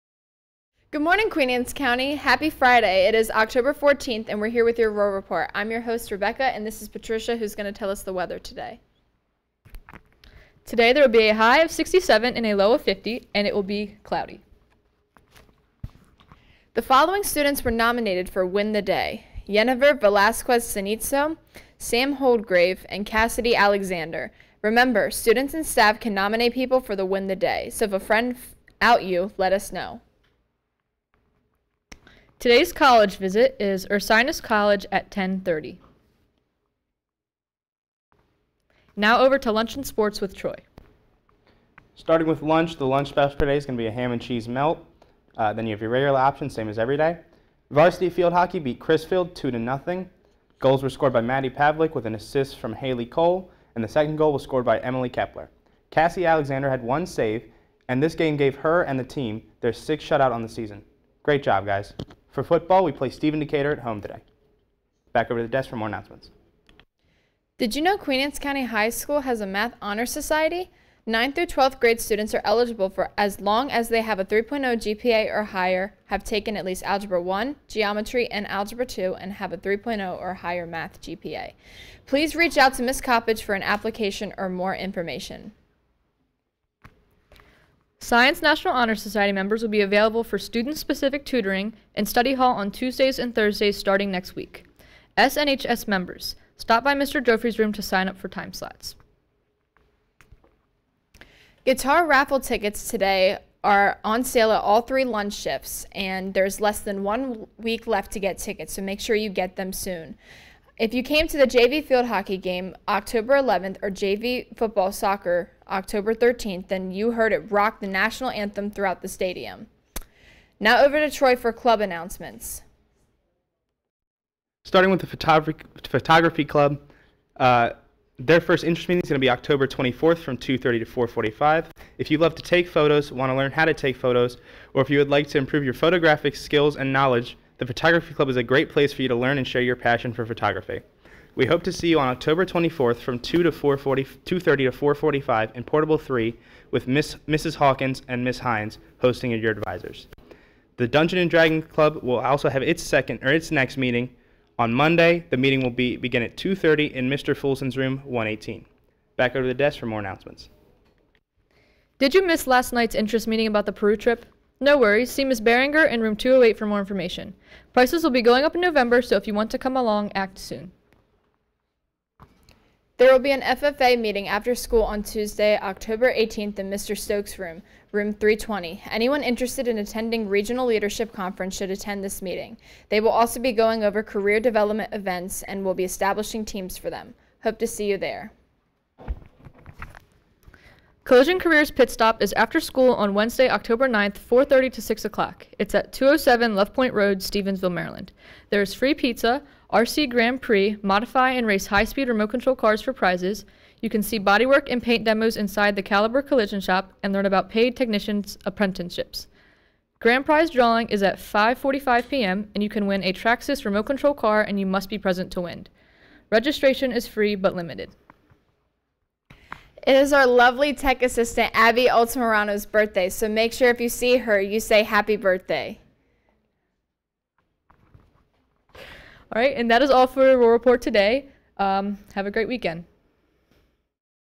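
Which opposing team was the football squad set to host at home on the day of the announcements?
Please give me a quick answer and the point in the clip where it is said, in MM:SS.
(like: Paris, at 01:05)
Stephen Decatur, at 01:03.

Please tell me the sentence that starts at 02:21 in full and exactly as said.
We hope to see you on October 24th from 2 to 4:30 2:30 to 4:45 in Portable 3 with Miss Mrs.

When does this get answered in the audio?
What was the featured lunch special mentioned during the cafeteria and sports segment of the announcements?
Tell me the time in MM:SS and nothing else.
00:43.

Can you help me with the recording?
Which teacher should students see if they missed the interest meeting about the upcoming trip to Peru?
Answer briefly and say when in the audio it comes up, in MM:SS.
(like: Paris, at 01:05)
Ms. Beringer, at 02:45.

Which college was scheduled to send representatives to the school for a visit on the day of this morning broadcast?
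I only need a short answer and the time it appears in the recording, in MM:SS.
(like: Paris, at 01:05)
Ursinus College, at 00:33.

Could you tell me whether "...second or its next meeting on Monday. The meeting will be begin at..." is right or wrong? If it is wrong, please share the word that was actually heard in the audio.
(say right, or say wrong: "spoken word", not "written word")
right.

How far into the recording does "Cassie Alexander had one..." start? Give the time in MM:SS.
00:55.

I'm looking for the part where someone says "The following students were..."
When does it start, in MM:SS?
00:16.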